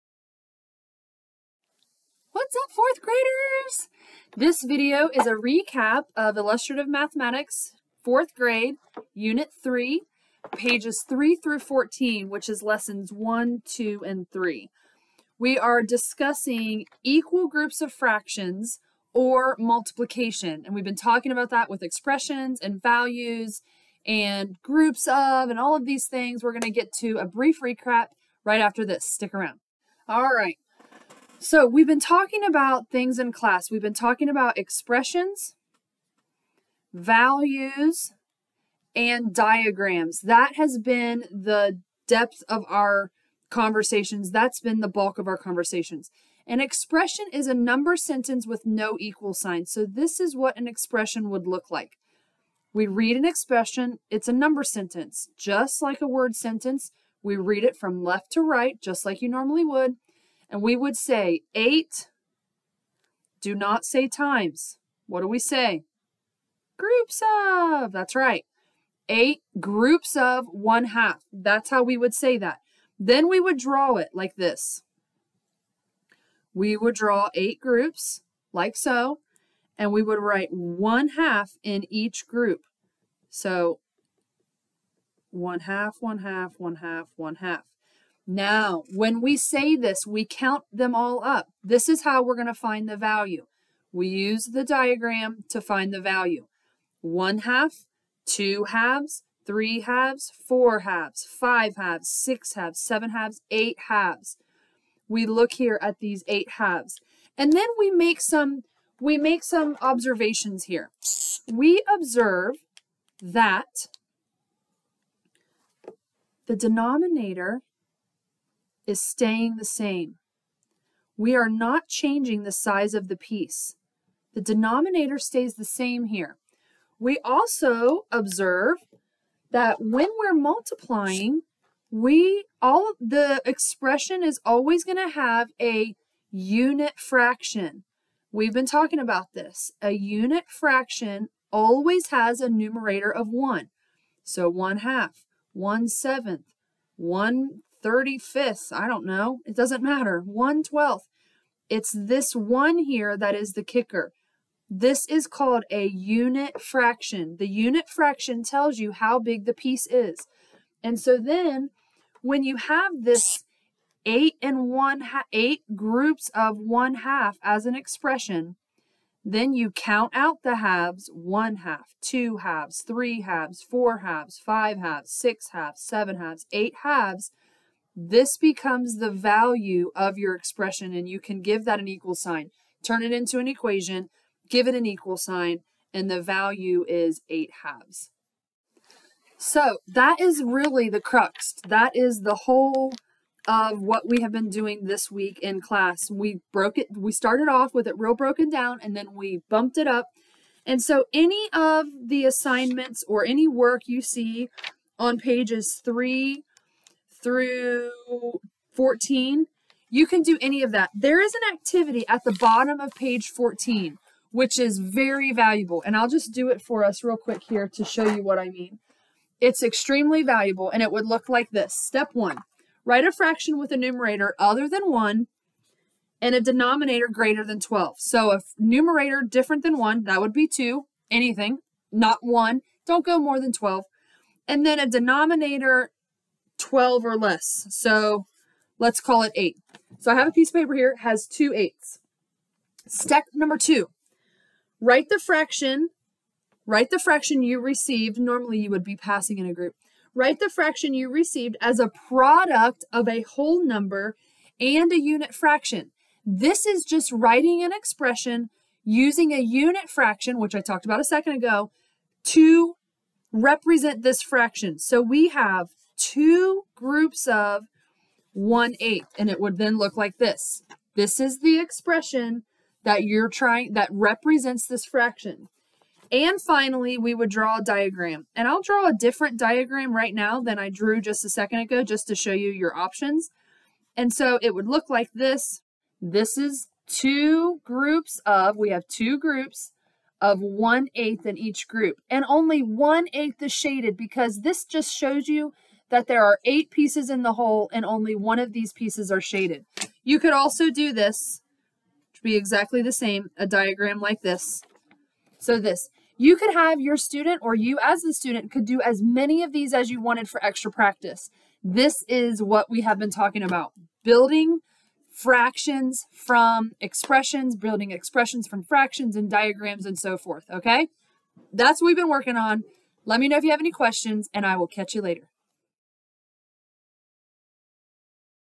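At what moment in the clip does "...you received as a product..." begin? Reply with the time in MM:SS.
04:10.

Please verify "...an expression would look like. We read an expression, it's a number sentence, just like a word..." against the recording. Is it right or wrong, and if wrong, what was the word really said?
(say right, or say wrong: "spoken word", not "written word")
right.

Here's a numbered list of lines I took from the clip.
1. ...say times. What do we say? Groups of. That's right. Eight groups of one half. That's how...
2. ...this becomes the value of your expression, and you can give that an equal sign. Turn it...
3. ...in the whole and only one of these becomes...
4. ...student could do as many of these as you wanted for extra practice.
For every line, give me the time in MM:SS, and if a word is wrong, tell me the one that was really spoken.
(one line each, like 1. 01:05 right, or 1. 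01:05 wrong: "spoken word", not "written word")
1. 01:03 right
2. 02:58 right
3. 04:57 wrong: "pieces", not "becomes"
4. 05:08 right.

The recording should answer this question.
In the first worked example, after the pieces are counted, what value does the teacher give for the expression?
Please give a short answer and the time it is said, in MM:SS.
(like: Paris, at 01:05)
8 halves, at 03:07.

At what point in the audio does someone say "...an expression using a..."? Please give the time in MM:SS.
04:17.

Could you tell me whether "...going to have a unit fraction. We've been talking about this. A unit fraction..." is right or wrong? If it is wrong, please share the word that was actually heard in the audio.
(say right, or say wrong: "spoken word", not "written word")
right.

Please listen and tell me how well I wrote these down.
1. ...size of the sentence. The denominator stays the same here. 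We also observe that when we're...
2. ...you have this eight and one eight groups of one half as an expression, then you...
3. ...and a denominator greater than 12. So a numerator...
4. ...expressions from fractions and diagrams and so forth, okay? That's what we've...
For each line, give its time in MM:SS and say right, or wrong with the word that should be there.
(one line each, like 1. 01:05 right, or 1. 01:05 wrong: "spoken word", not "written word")
1. 02:02 wrong: "piece", not "sentence"
2. 02:42 right
3. 03:46 right
4. 05:17 right.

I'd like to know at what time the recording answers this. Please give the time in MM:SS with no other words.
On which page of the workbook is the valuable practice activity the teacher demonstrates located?
03:32.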